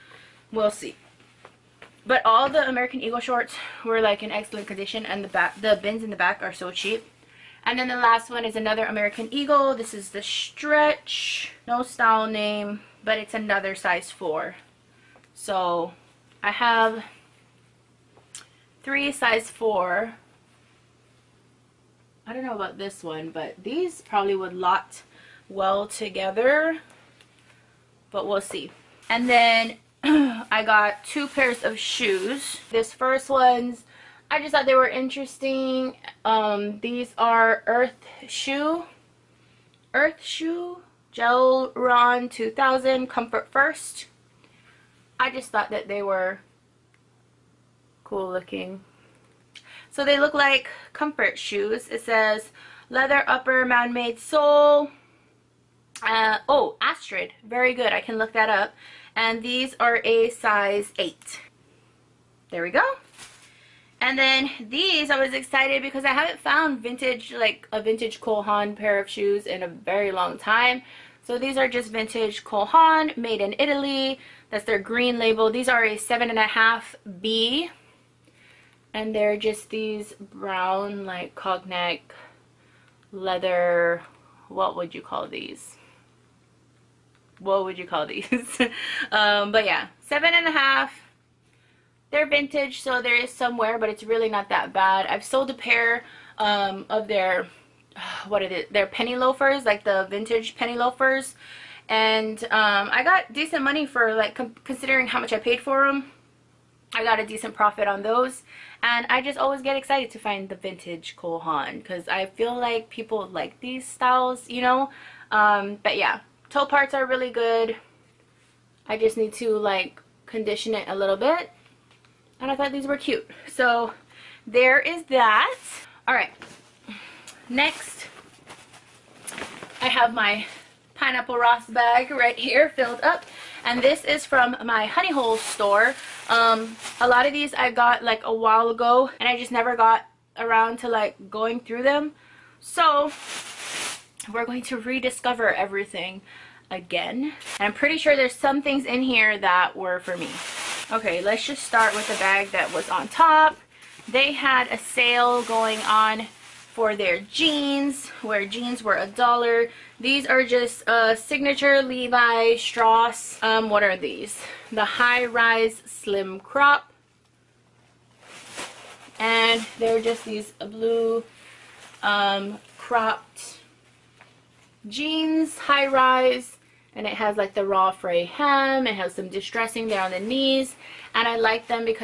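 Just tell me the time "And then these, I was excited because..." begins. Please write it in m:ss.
1:03.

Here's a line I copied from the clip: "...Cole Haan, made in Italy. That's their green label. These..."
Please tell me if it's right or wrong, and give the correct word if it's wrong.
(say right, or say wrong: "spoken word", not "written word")
right.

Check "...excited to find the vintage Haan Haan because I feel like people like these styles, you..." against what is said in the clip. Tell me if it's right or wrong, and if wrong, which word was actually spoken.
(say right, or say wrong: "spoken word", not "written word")
wrong: "Cole", not "Haan".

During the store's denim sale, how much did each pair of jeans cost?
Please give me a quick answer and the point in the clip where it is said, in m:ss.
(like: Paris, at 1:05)
$1, at 2:38.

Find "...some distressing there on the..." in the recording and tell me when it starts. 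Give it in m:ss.
2:59.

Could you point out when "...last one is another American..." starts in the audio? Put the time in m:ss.
0:07.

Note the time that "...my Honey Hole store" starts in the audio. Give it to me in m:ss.
2:14.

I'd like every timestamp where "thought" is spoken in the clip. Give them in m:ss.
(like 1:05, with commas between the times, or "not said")
0:34, 0:45, 2:02.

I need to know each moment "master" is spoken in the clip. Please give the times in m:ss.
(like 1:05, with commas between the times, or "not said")
not said.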